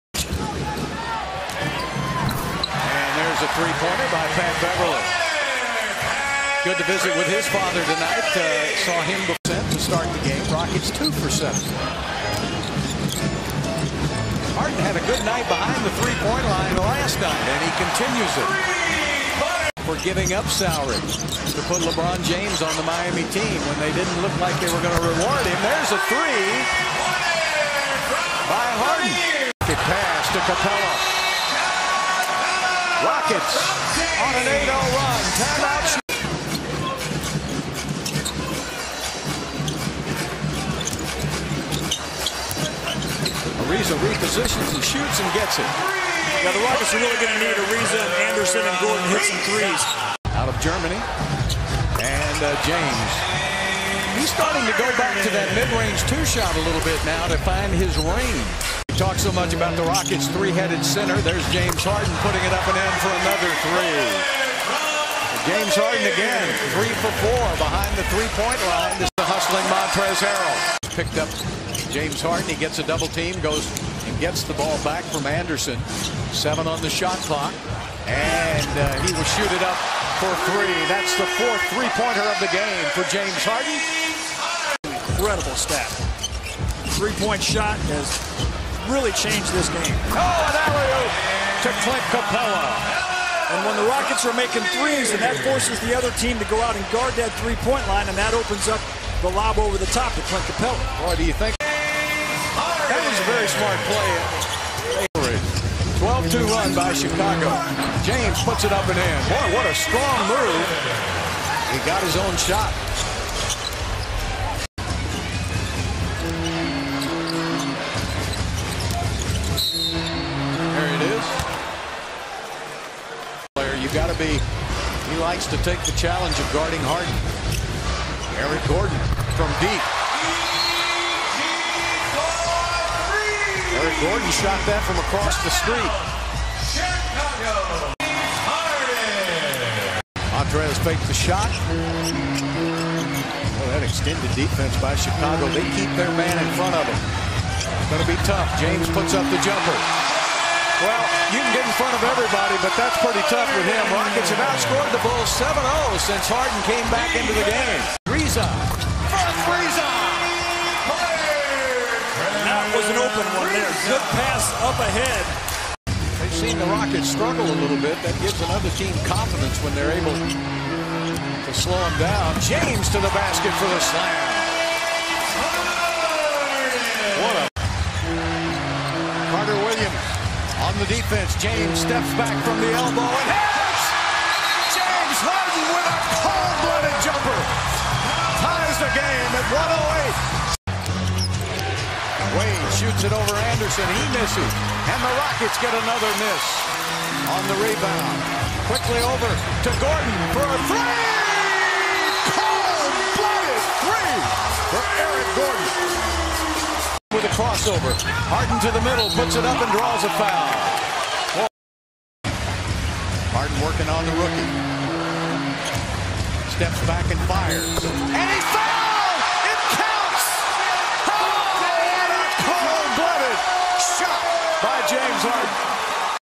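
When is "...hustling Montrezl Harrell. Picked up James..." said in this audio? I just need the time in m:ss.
1:09.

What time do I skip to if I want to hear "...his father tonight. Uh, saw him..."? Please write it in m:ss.
0:07.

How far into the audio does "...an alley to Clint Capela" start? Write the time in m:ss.
1:30.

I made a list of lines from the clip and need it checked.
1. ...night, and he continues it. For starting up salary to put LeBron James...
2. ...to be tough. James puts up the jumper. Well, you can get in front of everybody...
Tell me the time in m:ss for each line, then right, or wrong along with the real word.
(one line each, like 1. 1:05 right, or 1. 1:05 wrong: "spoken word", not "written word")
1. 0:17 wrong: "giving", not "starting"
2. 2:28 right.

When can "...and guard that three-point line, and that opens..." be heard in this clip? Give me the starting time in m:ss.
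1:36.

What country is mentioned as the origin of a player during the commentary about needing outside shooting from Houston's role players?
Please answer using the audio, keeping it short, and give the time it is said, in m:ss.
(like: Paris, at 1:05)
Germany, at 0:50.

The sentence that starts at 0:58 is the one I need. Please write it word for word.
Talk so much about the Rockets' three-headed center.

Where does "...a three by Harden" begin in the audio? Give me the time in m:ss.
0:25.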